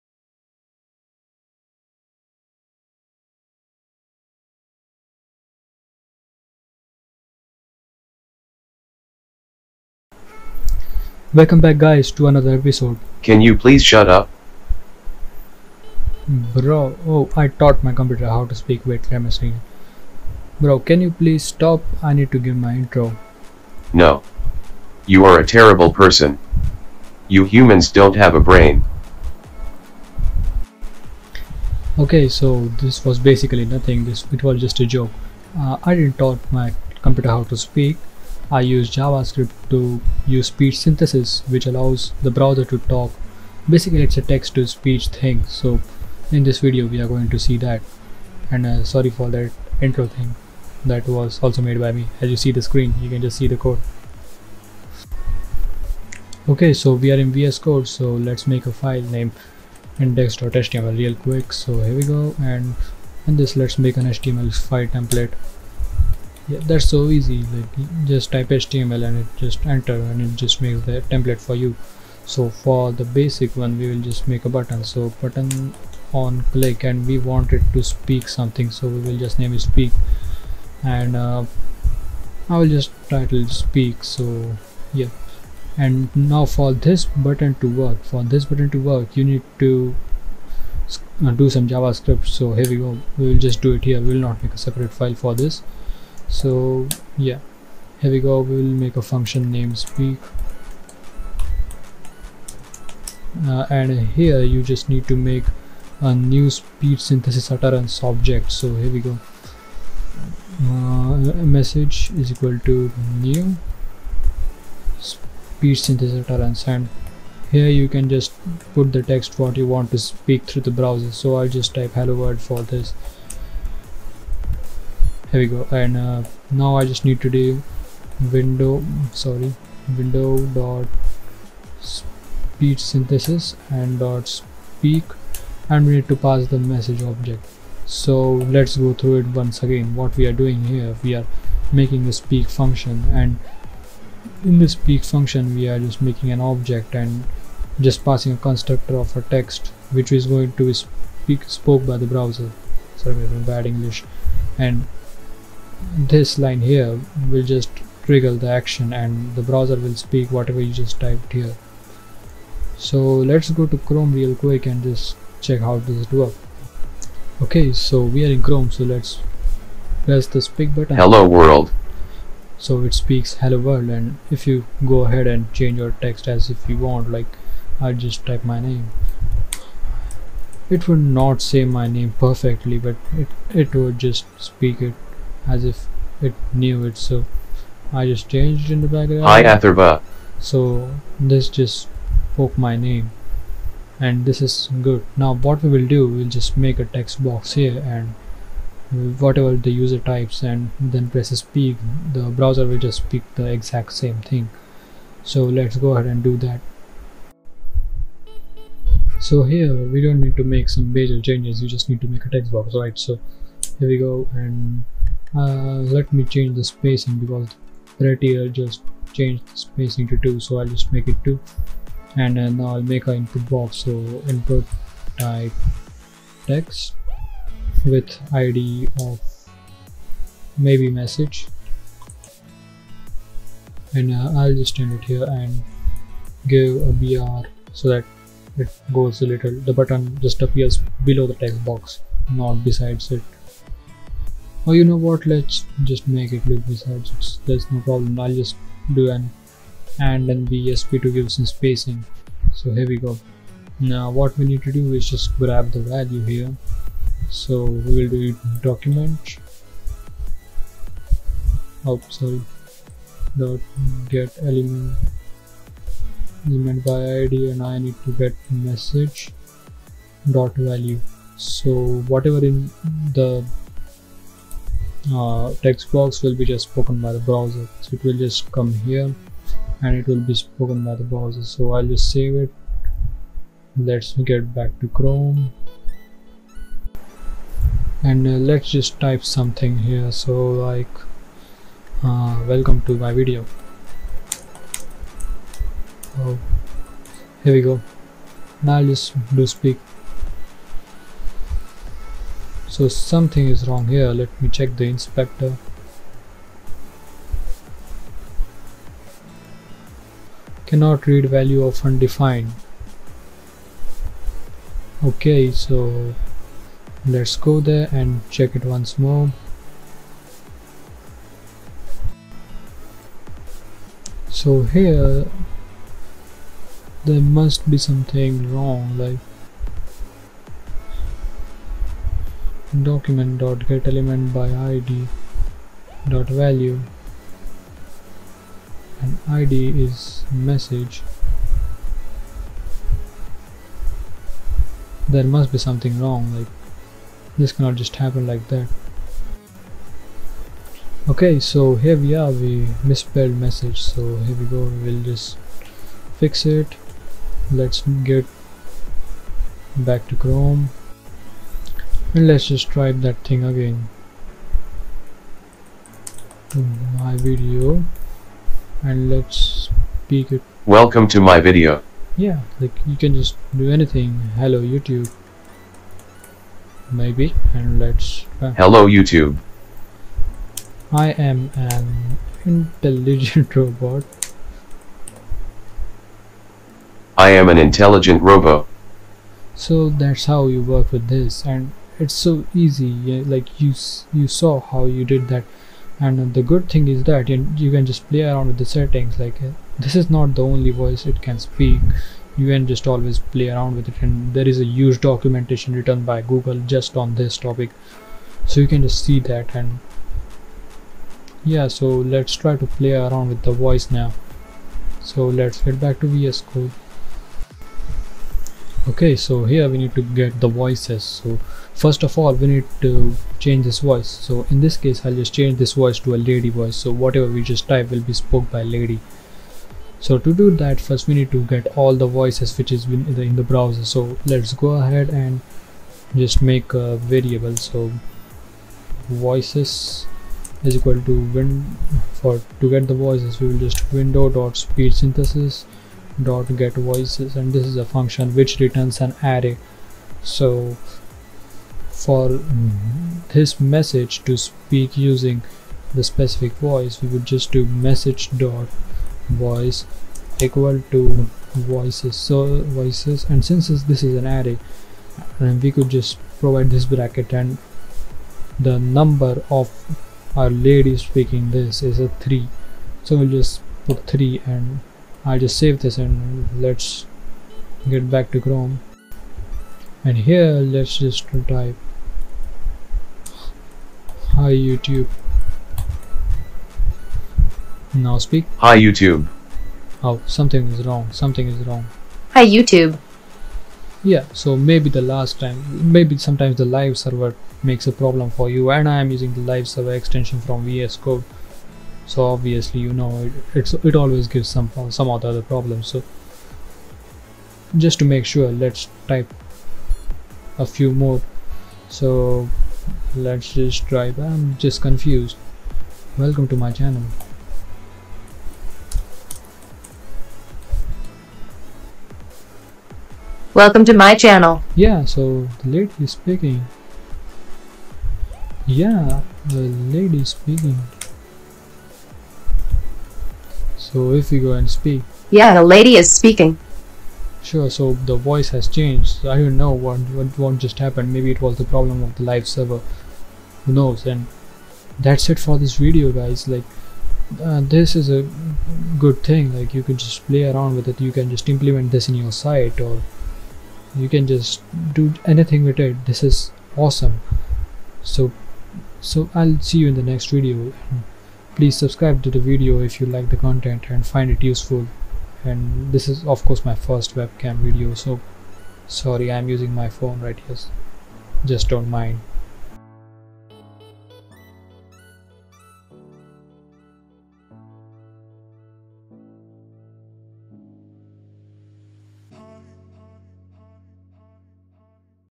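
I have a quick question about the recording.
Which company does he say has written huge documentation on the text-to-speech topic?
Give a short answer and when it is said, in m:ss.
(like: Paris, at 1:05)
Google, at 6:46.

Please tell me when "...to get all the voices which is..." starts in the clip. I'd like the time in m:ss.
7:11.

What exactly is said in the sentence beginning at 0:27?
You humans don't have a brain.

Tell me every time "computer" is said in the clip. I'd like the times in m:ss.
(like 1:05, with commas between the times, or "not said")
0:17, 0:37.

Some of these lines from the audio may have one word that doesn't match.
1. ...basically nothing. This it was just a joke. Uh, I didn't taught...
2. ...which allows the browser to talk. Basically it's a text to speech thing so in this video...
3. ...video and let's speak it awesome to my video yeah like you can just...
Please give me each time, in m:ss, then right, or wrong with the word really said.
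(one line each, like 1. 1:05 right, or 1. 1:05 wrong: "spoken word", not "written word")
1. 0:33 right
2. 0:41 right
3. 6:07 wrong: "welcome", not "awesome".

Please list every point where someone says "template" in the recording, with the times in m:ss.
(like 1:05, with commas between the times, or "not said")
1:04, 1:11.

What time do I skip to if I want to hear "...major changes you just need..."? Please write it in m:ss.
3:30.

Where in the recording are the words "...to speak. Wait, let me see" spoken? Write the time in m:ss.
0:18.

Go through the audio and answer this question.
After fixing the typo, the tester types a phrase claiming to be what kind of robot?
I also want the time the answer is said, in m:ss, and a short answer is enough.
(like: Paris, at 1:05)
intelligent robot, at 6:27.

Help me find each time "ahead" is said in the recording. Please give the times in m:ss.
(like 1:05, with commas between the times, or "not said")
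2:55, 3:25, 7:14.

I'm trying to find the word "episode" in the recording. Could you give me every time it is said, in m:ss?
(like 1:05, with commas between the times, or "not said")
0:12.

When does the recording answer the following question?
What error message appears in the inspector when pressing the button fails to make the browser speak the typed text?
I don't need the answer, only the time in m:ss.
5:10.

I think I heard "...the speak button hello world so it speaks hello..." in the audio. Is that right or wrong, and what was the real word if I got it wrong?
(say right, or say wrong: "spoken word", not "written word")
right.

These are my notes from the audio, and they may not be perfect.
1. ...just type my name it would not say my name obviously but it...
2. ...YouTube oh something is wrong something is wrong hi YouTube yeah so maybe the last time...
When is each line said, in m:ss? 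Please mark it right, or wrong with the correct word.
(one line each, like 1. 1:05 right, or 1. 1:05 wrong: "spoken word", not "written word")
1. 2:57 wrong: "perfectly", not "obviously"
2. 8:08 right.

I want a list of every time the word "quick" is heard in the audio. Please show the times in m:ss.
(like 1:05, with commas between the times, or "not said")
1:01, 2:44.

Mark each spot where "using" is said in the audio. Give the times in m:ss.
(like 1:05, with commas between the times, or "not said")
7:34, 8:19, 9:29.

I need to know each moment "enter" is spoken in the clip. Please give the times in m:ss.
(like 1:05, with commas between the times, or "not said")
1:09.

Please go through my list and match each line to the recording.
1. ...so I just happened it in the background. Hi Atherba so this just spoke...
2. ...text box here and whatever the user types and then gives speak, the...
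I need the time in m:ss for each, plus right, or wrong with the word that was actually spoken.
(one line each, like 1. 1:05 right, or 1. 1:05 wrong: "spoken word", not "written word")
1. 3:06 wrong: "changed", not "happened"
2. 3:16 wrong: "presses", not "gives".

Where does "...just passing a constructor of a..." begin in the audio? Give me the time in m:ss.
2:27.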